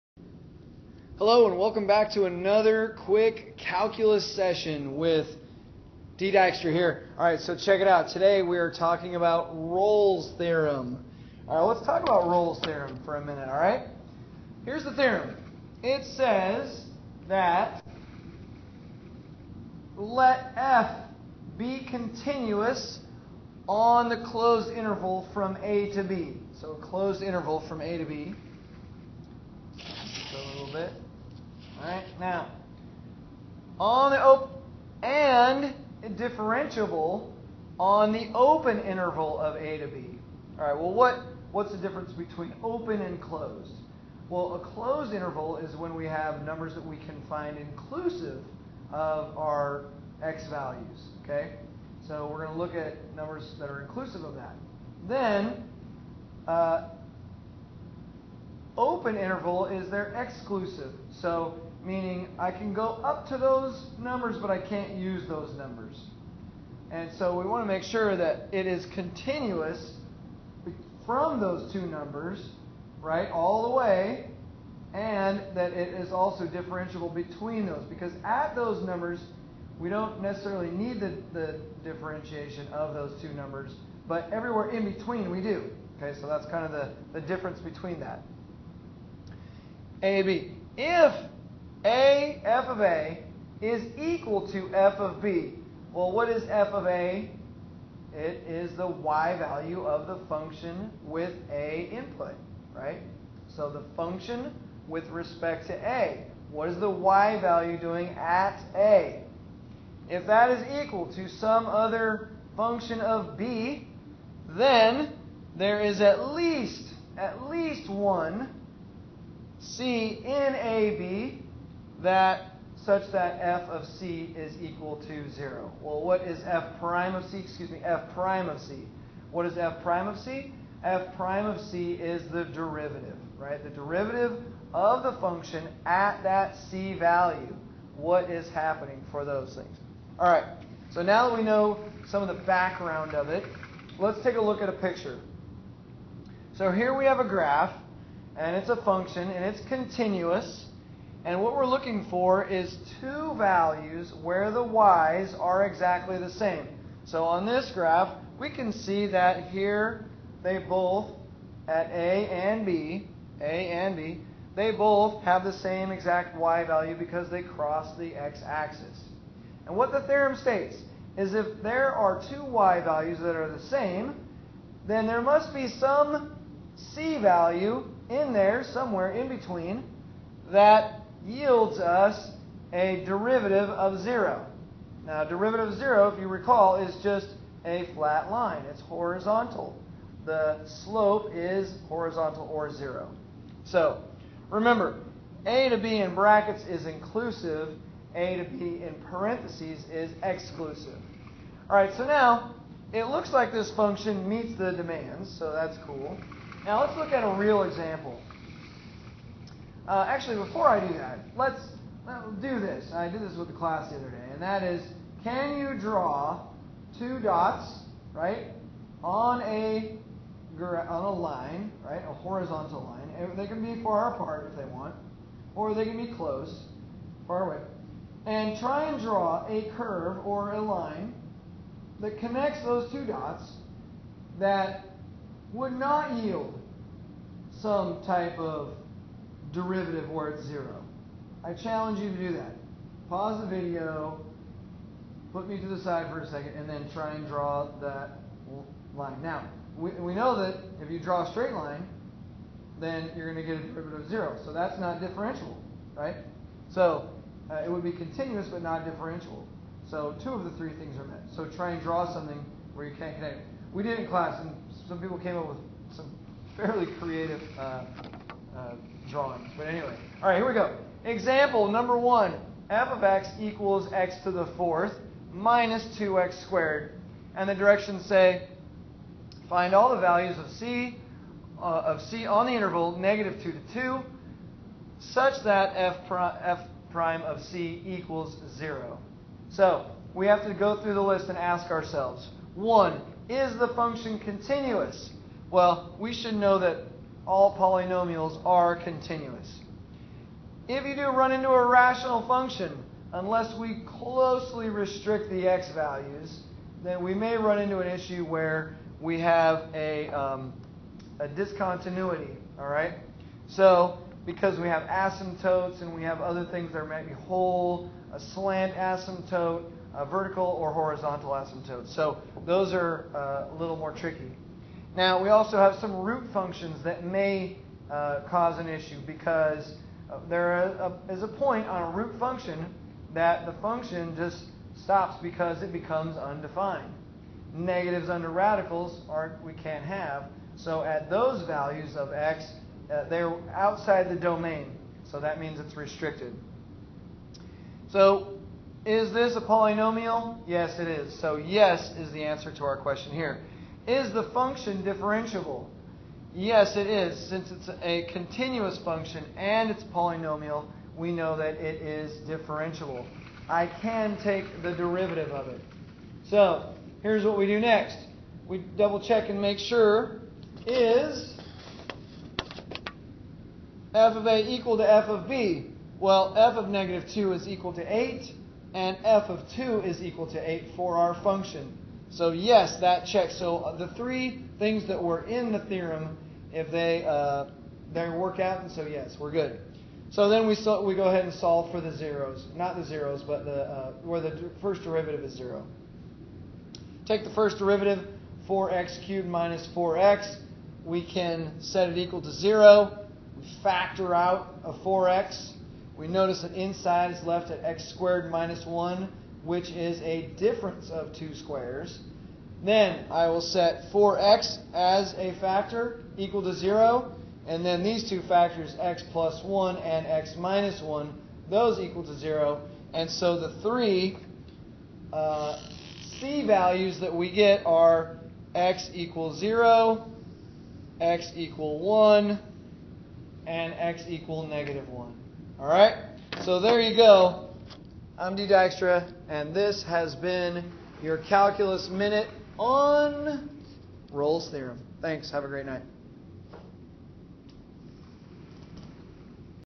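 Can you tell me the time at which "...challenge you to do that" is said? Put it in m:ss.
4:01.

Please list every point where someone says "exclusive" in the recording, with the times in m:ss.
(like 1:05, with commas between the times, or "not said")
1:00, 3:20.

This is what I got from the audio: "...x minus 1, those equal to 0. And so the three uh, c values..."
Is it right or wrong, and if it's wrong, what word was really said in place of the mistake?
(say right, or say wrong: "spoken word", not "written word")
right.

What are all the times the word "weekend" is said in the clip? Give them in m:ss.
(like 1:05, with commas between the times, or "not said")
not said.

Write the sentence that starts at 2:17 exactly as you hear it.
What is happening for those things?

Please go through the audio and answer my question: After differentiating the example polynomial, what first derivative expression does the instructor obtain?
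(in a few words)
4x^3 - 4x.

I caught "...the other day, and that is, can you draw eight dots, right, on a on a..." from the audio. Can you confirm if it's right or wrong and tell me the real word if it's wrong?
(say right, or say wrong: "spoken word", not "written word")
wrong: "two", not "eight".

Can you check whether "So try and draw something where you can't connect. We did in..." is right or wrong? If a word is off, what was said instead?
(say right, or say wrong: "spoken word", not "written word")
right.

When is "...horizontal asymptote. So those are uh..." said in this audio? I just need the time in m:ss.
5:20.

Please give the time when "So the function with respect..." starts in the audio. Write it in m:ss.
1:43.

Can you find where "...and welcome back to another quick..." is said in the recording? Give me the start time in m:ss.
0:01.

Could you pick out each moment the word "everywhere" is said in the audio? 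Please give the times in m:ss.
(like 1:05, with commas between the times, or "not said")
1:24.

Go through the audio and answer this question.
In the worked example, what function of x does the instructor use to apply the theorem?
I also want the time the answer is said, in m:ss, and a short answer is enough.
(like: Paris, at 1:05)
x^4 - 2x^2, at 4:33.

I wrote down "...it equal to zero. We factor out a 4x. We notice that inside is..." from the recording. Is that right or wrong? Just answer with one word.
right.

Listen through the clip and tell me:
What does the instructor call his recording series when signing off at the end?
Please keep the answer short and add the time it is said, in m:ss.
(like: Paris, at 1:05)
Calculus Minute, at 7:21.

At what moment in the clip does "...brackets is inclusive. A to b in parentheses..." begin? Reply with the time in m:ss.
3:16.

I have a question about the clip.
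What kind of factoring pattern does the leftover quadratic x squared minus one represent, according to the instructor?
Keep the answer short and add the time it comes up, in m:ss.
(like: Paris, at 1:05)
Difference of two squares, at 6:50.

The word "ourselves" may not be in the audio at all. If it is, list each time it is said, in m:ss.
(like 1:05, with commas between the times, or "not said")
4:51.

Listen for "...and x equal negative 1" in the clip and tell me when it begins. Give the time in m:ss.
7:13.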